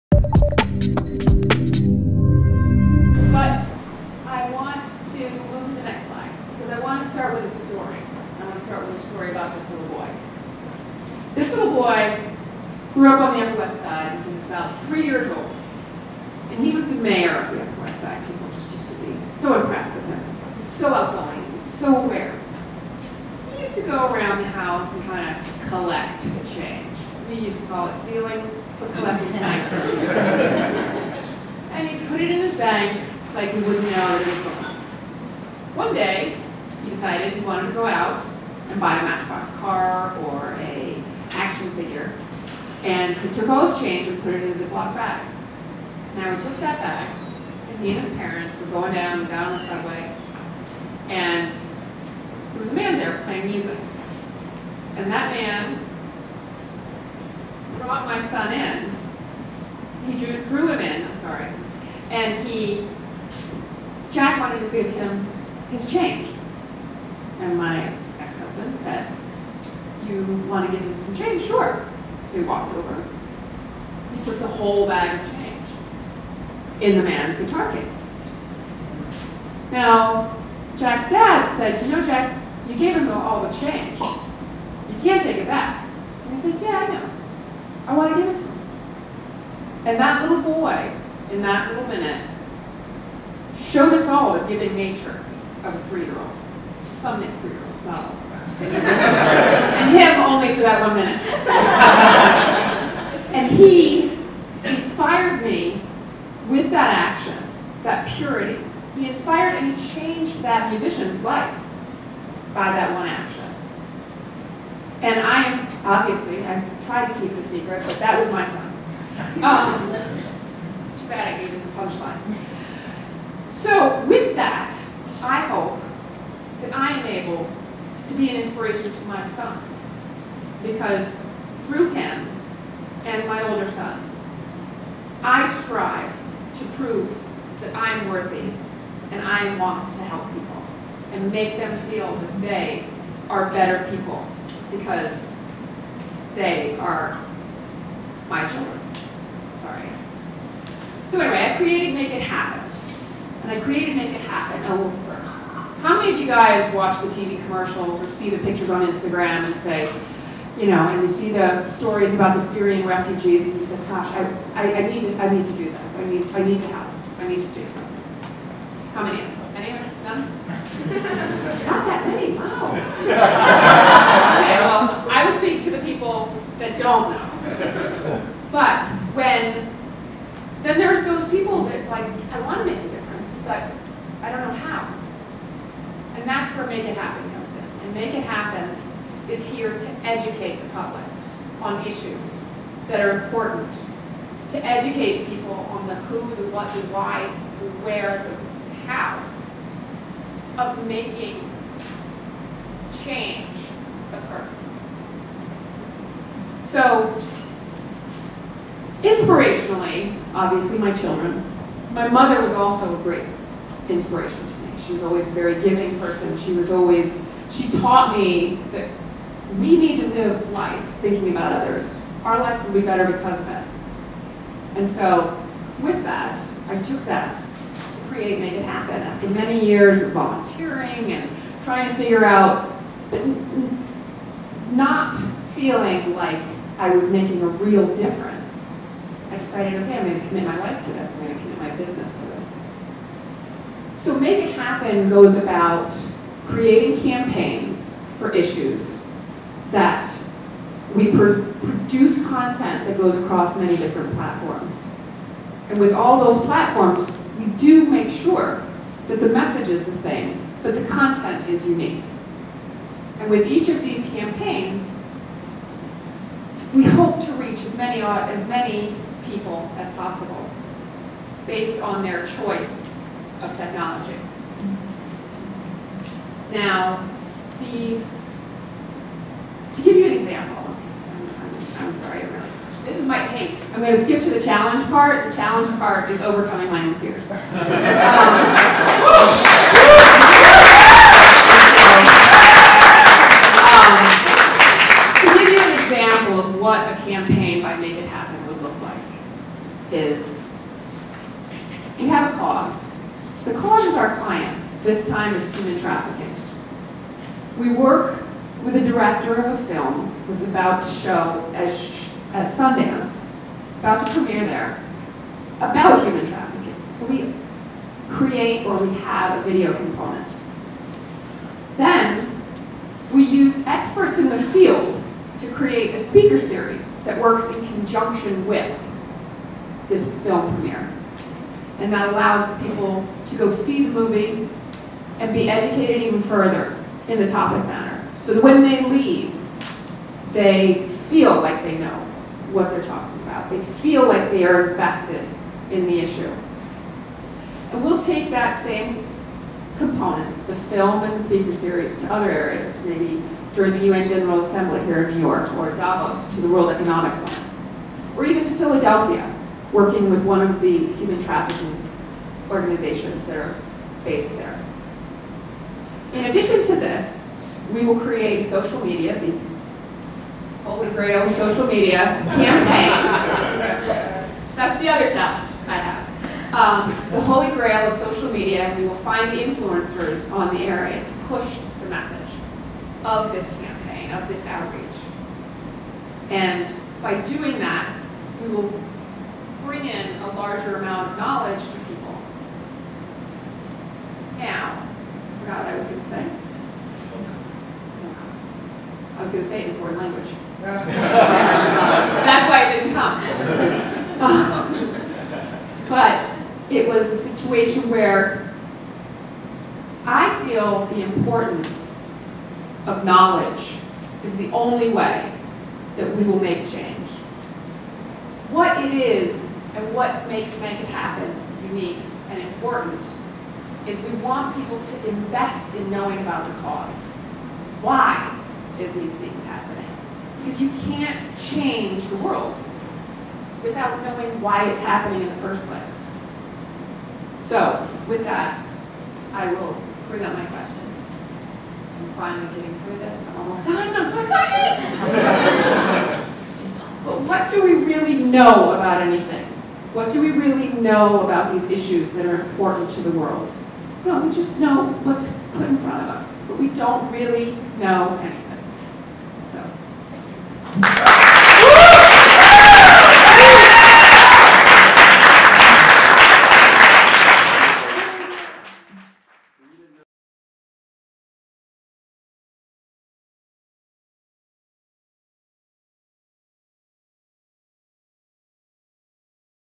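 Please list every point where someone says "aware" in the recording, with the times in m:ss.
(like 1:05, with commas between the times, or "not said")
0:22.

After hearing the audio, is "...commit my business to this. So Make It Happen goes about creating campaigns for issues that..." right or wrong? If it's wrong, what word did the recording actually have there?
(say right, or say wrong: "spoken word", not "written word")
right.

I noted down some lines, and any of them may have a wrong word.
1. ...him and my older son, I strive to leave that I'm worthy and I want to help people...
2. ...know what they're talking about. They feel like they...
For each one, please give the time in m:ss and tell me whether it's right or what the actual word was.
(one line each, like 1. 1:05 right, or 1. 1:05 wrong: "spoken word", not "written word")
1. 2:11 wrong: "prove", not "leave"
2. 5:41 right.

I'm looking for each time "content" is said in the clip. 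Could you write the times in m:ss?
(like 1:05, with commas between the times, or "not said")
4:12, 4:20.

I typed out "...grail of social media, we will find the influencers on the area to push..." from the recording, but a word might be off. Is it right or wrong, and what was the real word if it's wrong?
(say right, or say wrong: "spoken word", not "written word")
right.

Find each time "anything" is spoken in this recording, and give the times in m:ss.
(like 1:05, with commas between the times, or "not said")
7:29, 7:38.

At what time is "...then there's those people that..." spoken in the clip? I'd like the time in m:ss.
3:00.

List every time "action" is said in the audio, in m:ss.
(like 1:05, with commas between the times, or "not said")
0:41, 1:46, 1:53.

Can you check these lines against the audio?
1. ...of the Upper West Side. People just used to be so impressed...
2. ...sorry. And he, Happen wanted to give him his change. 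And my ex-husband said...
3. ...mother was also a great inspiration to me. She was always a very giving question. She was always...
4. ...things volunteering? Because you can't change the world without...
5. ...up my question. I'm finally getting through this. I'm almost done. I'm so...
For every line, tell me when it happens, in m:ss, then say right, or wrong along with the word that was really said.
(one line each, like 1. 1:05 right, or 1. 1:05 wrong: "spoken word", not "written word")
1. 0:17 right
2. 1:01 wrong: "Jack", not "Happen"
3. 3:32 wrong: "person", not "question"
4. 7:09 wrong: "happening", not "volunteering"
5. 7:20 right.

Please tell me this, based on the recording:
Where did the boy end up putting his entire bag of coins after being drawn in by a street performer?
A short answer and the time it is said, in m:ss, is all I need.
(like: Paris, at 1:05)
In the man's guitar case, at 1:17.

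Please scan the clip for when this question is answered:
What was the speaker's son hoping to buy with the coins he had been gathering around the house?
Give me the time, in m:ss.
0:39.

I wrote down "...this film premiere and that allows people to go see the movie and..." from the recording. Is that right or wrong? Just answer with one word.
right.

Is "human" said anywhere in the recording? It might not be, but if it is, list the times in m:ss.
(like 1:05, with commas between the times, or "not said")
5:05, 5:16, 6:00.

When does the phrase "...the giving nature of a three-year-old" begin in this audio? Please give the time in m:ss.
1:34.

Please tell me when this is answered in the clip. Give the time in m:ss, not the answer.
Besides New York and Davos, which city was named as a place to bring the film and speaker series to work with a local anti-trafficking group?
5:58.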